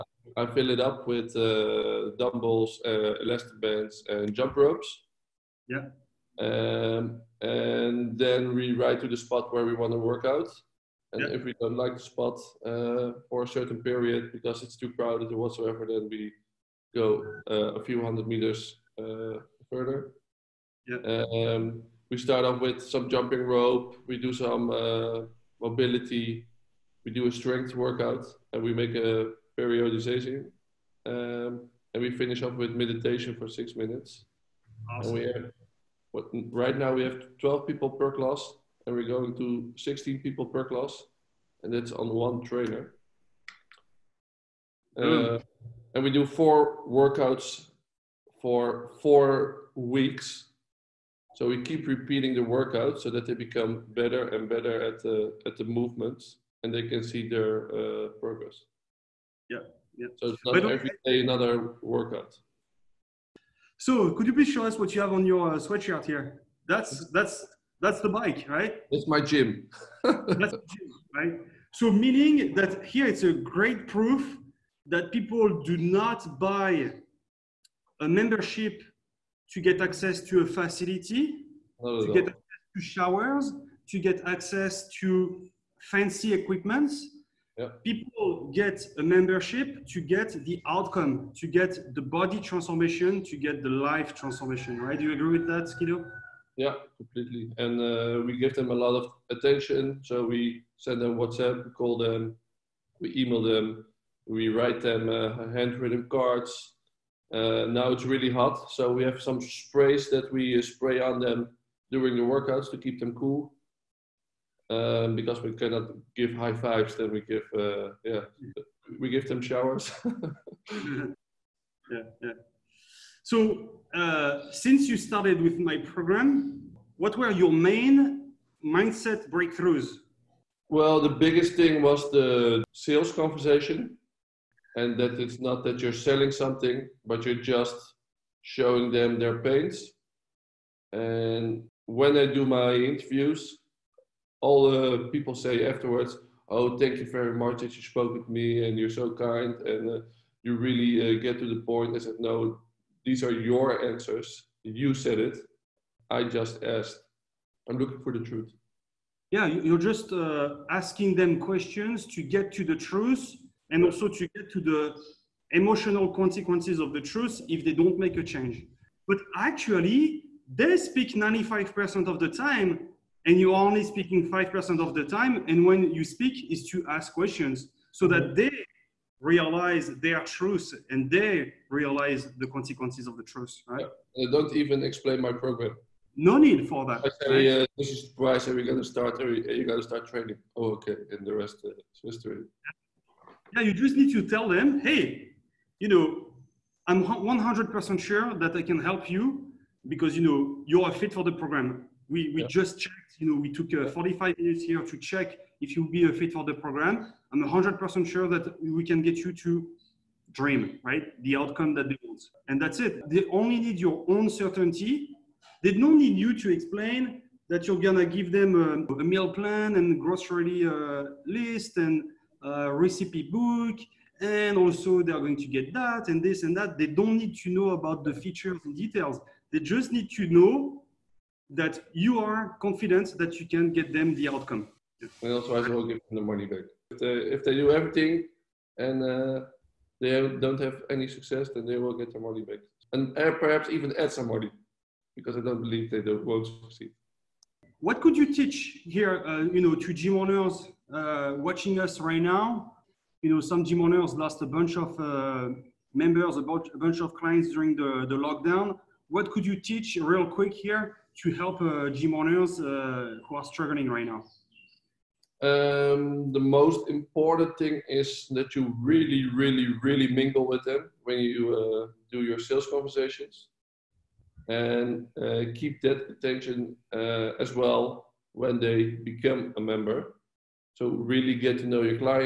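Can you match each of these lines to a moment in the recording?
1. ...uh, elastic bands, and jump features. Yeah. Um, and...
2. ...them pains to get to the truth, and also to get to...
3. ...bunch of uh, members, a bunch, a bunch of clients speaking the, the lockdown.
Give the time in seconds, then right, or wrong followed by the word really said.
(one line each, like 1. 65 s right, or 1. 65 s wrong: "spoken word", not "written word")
1. 2 s wrong: "ropes", not "features"
2. 161 s wrong: "questions", not "pains"
3. 254 s wrong: "during", not "speaking".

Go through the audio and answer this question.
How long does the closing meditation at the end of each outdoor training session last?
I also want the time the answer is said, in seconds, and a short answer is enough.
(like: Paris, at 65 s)
6 minutes, at 33 s.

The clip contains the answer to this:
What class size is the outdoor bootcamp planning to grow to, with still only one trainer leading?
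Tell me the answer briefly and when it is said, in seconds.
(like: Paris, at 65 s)
16 people, at 39 s.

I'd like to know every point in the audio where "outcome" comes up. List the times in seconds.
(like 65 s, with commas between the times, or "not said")
90 s, 211 s, 234 s.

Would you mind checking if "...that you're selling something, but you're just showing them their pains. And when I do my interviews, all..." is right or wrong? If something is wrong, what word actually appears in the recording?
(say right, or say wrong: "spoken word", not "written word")
right.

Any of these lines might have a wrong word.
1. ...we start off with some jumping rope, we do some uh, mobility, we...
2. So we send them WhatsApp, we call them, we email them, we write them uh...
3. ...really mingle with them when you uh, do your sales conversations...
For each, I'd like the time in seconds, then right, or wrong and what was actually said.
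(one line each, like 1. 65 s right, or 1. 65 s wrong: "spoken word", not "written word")
1. 22 s right
2. 100 s right
3. 269 s right.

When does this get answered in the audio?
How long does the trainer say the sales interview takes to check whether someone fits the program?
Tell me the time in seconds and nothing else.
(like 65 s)
203 s.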